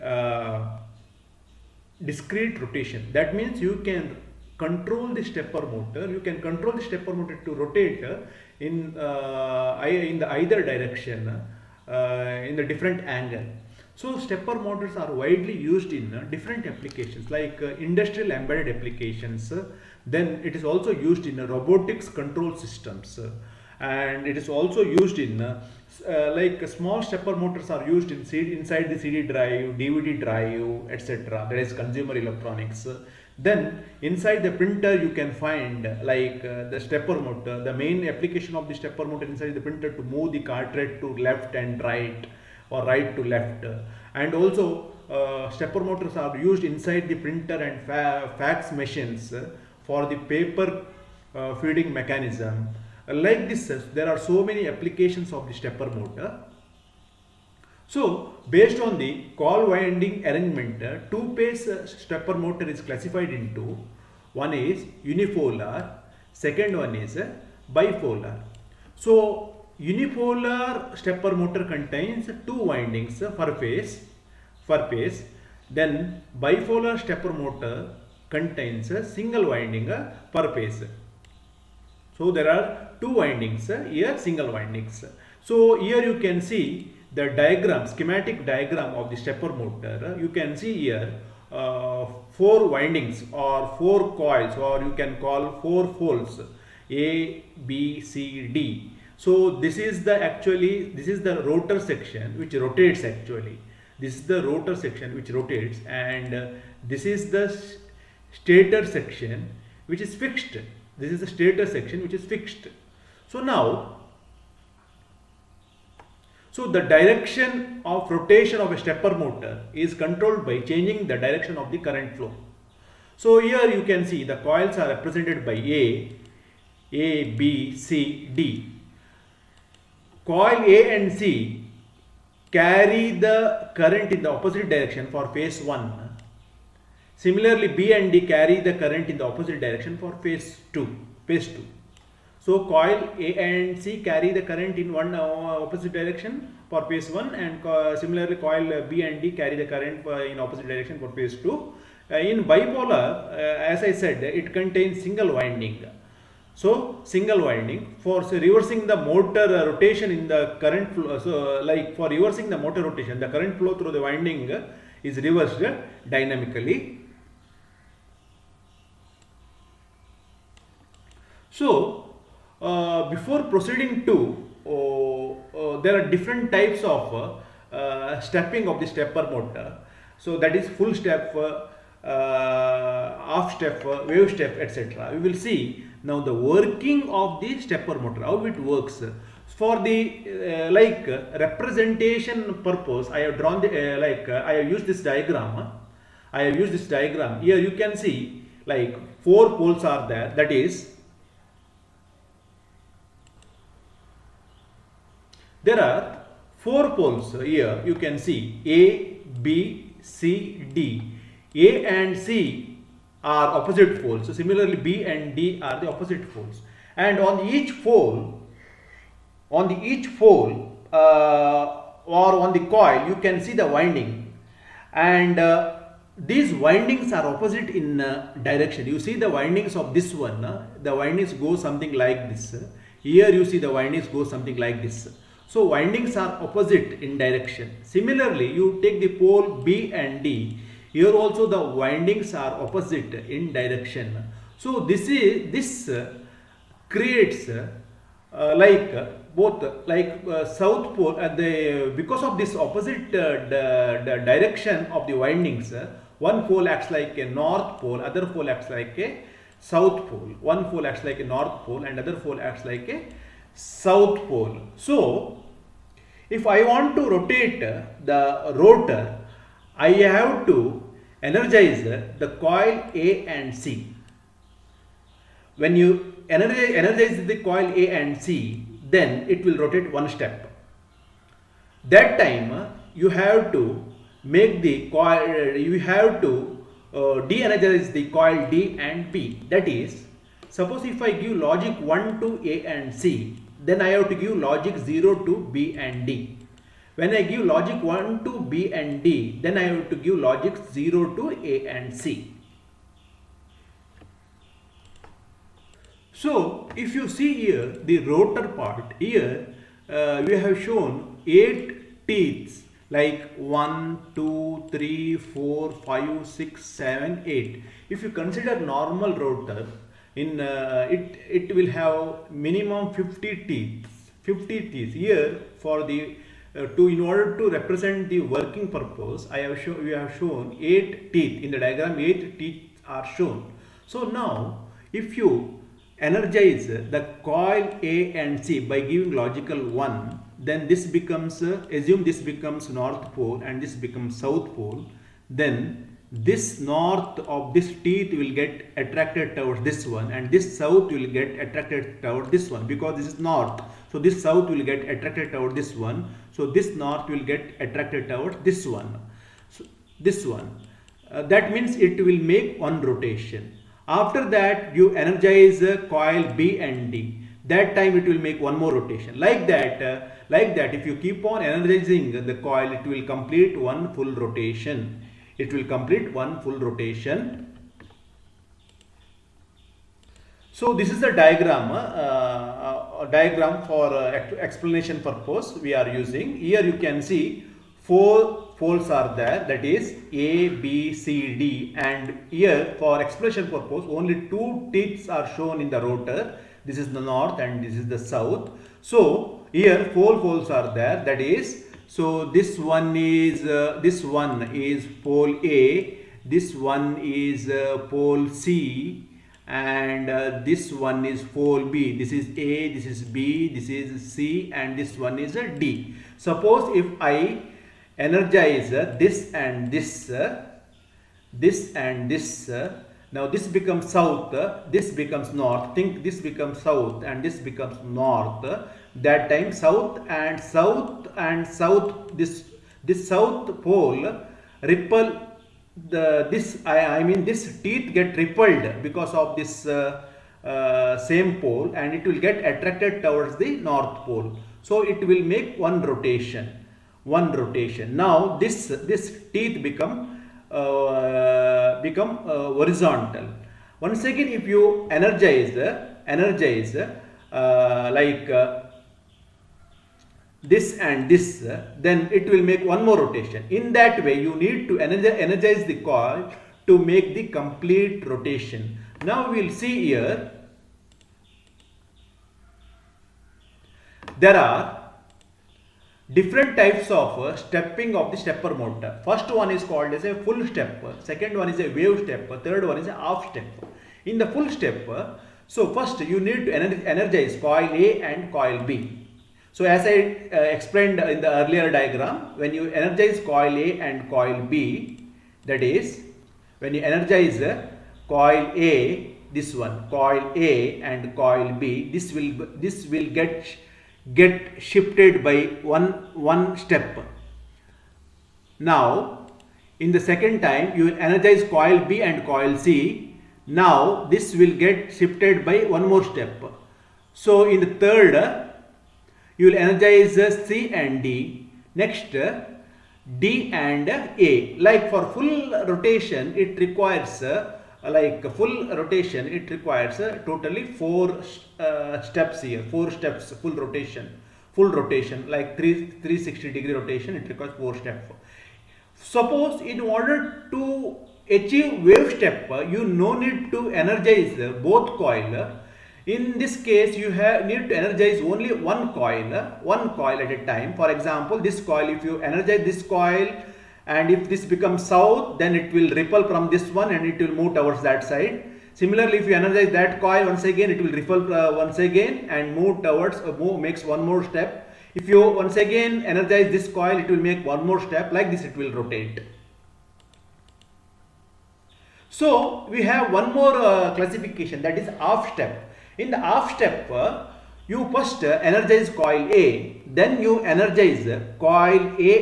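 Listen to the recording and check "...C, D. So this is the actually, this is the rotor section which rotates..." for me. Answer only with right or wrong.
right.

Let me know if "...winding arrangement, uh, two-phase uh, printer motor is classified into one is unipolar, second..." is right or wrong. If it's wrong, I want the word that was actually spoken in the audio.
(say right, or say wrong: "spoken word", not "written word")
wrong: "stepper", not "printer".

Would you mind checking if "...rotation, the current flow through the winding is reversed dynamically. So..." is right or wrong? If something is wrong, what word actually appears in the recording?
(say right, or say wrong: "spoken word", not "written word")
right.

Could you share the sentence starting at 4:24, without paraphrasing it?
So, if I want to rotate the rotor, I have to energize the coil A and C.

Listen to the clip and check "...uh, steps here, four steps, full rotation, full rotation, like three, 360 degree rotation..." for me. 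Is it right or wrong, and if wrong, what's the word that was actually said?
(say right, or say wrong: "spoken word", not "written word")
right.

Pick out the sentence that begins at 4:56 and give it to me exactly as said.
When I give logic 1 to B and D, then I have to give logic 0 to A and C.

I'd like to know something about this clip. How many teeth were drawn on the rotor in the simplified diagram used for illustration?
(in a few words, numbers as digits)
8.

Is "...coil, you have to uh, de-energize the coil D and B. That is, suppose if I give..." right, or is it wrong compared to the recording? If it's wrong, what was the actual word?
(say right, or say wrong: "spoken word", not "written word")
right.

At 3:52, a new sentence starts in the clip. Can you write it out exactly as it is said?
Here you see the windings go something like this.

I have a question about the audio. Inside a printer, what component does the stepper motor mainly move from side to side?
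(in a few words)
cartridge.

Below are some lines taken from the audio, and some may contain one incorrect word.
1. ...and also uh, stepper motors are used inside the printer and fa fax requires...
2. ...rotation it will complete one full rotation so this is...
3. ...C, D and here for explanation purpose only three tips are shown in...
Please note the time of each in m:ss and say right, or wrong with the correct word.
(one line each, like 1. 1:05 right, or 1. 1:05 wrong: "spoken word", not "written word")
1. 0:44 wrong: "machines", not "requires"
2. 6:14 right
3. 6:30 wrong: "two", not "three".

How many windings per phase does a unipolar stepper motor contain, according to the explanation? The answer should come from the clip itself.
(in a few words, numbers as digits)
2.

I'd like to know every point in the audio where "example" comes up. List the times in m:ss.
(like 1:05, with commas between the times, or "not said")
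9:10.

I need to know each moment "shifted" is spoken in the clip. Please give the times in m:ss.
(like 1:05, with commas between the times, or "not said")
8:24, 8:34.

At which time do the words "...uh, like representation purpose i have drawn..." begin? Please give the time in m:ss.
3:09.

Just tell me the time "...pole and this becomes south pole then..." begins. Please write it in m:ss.
5:43.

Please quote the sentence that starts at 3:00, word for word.
So that is full step, half step, wave step, etc.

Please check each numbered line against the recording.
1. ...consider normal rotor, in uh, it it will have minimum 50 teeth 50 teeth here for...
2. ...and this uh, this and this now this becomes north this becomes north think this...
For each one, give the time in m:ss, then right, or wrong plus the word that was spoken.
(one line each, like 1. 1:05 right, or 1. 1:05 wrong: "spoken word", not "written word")
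1. 5:18 right
2. 6:59 wrong: "south", not "north".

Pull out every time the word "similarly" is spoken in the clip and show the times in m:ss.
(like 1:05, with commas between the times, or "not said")
2:17, 2:27, 3:34, 3:57, 9:18.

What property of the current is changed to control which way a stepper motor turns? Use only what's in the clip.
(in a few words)
direction of the current flow.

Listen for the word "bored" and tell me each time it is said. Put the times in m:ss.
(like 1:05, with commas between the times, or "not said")
not said.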